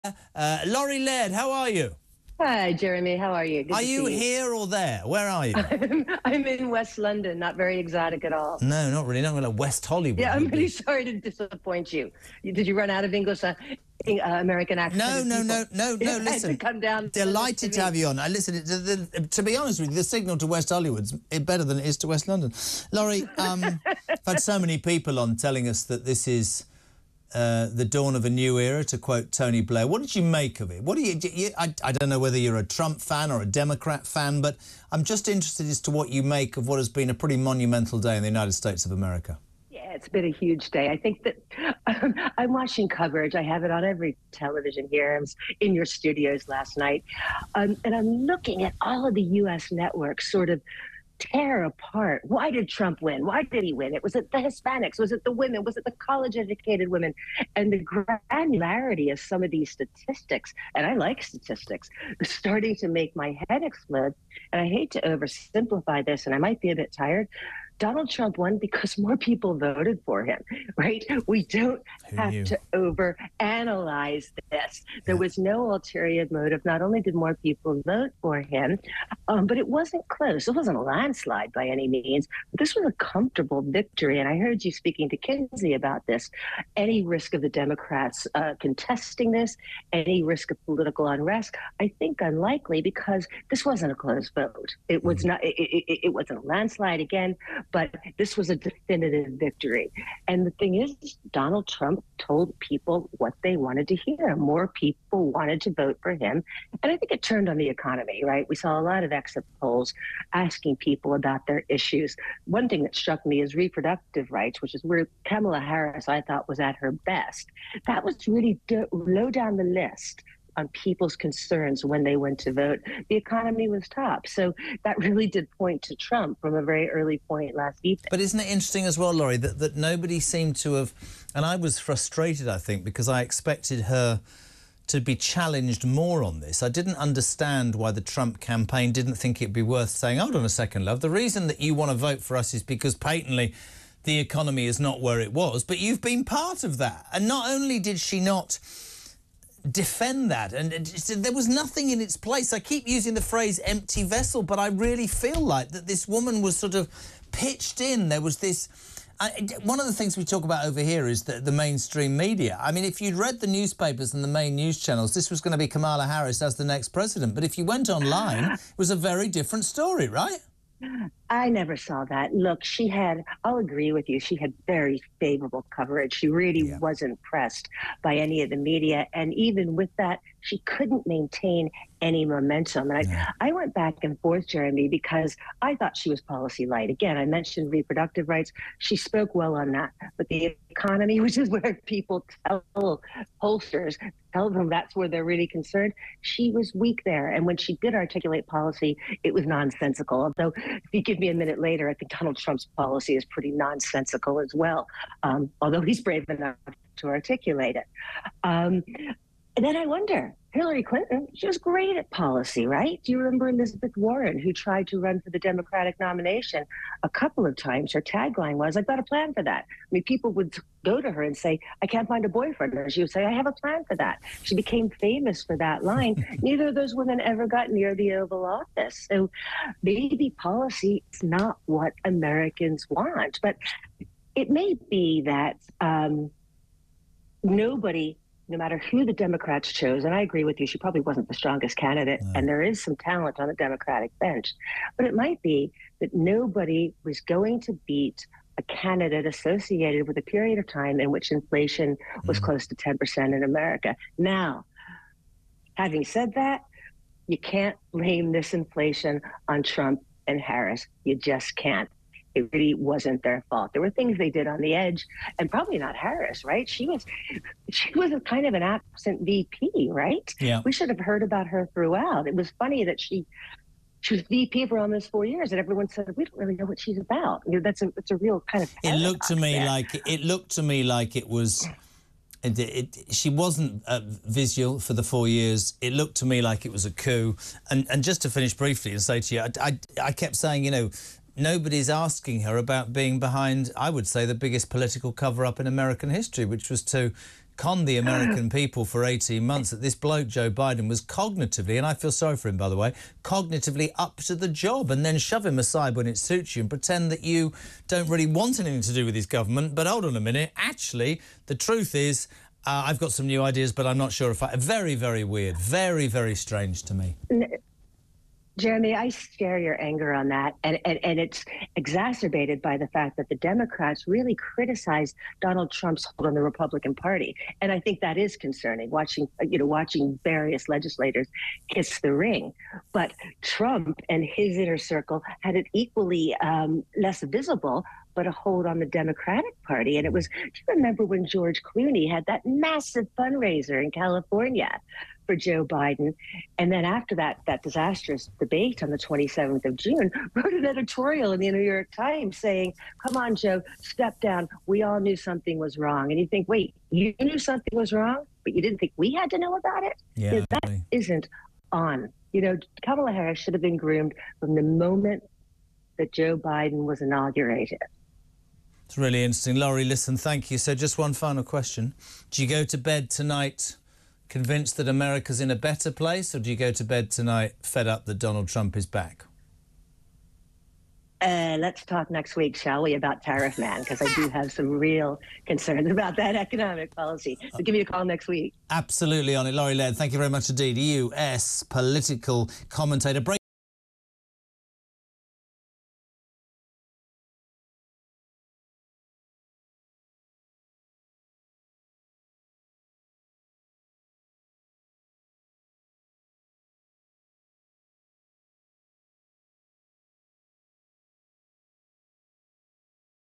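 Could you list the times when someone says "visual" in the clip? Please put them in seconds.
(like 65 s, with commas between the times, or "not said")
284 s.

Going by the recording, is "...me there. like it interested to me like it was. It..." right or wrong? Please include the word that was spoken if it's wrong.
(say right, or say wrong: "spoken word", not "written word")
wrong: "looked", not "interested".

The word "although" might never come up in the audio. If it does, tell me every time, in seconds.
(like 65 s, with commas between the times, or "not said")
200 s, 205 s.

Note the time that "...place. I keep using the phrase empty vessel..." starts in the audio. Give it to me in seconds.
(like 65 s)
152 s.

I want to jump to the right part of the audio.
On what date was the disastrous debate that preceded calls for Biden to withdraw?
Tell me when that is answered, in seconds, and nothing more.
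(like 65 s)
348 s.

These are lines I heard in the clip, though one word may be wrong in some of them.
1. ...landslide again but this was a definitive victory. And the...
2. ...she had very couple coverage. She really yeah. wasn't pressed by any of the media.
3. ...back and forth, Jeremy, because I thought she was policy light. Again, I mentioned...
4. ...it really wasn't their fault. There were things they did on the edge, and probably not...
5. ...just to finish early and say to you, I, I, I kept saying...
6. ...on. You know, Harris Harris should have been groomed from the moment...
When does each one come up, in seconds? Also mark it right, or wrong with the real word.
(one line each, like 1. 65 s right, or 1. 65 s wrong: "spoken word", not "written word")
1. 96 s right
2. 174 s wrong: "favorable", not "couple"
3. 183 s right
4. 262 s right
5. 288 s wrong: "briefly", not "early"
6. 361 s wrong: "Kamala", not "Harris".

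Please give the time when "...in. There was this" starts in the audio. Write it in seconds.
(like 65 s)
157 s.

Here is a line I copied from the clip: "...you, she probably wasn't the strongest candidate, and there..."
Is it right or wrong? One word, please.
right.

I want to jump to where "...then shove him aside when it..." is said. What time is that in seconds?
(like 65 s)
305 s.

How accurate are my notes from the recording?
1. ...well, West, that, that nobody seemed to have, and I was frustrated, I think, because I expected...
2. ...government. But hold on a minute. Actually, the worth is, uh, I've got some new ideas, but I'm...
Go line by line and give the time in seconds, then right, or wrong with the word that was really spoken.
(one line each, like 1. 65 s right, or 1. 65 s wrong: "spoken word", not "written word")
1. 128 s wrong: "Laurie", not "West"
2. 309 s wrong: "truth", not "worth".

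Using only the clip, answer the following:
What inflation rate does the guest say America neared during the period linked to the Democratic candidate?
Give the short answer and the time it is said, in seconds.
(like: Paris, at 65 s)
10%, at 252 s.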